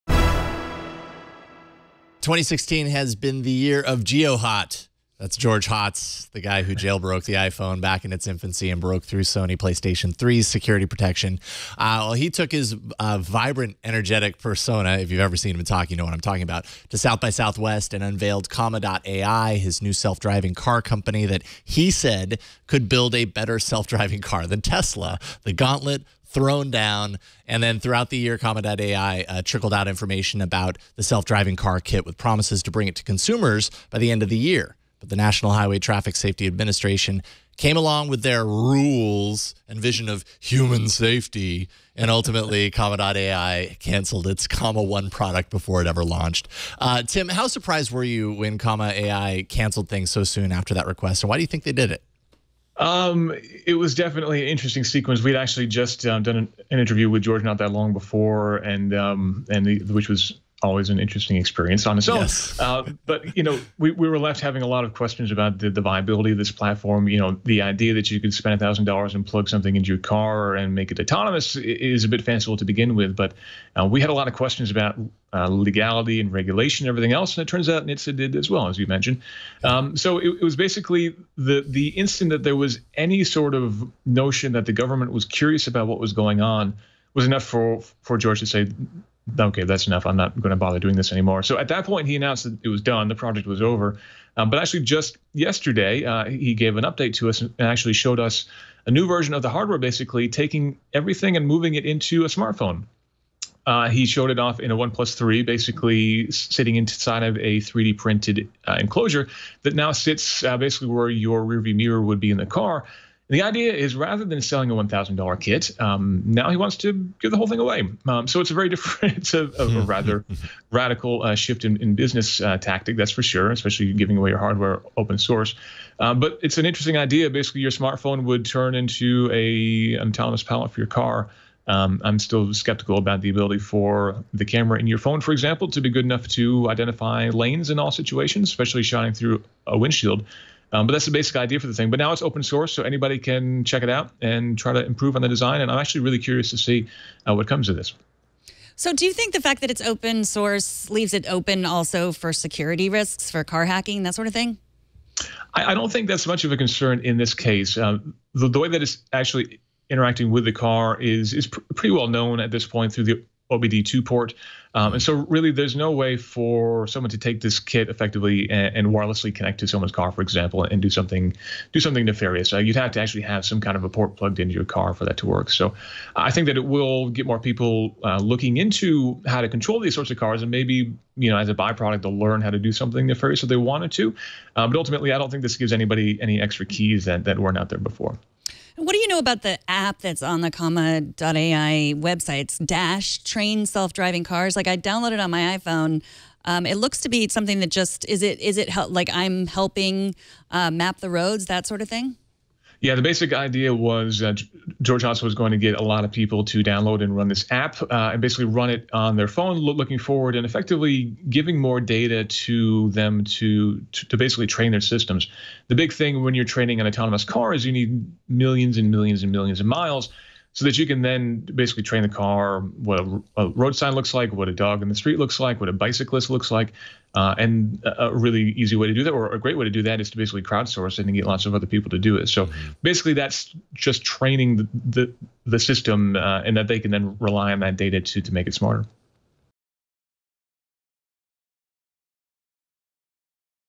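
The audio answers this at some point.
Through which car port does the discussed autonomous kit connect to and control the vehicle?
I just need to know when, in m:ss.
2:43.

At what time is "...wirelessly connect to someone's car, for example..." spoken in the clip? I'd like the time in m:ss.
2:48.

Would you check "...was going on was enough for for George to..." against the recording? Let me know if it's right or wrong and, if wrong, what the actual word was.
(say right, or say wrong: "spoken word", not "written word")
right.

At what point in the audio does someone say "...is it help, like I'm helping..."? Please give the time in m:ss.
3:18.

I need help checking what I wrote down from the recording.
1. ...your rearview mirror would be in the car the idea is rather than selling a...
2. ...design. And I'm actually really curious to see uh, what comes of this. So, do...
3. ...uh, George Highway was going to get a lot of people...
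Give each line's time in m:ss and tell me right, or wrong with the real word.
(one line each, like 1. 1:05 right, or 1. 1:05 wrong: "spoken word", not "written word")
1. 1:51 right
2. 2:25 right
3. 3:24 wrong: "Hotz", not "Highway".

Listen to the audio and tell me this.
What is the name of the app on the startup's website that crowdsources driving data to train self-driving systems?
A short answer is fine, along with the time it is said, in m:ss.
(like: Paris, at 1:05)
Dash, at 3:12.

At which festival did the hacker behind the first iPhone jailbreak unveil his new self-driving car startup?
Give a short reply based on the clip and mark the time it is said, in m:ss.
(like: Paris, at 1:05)
South by Southwest, at 0:16.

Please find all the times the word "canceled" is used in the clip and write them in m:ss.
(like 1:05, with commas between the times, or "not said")
0:43, 0:49.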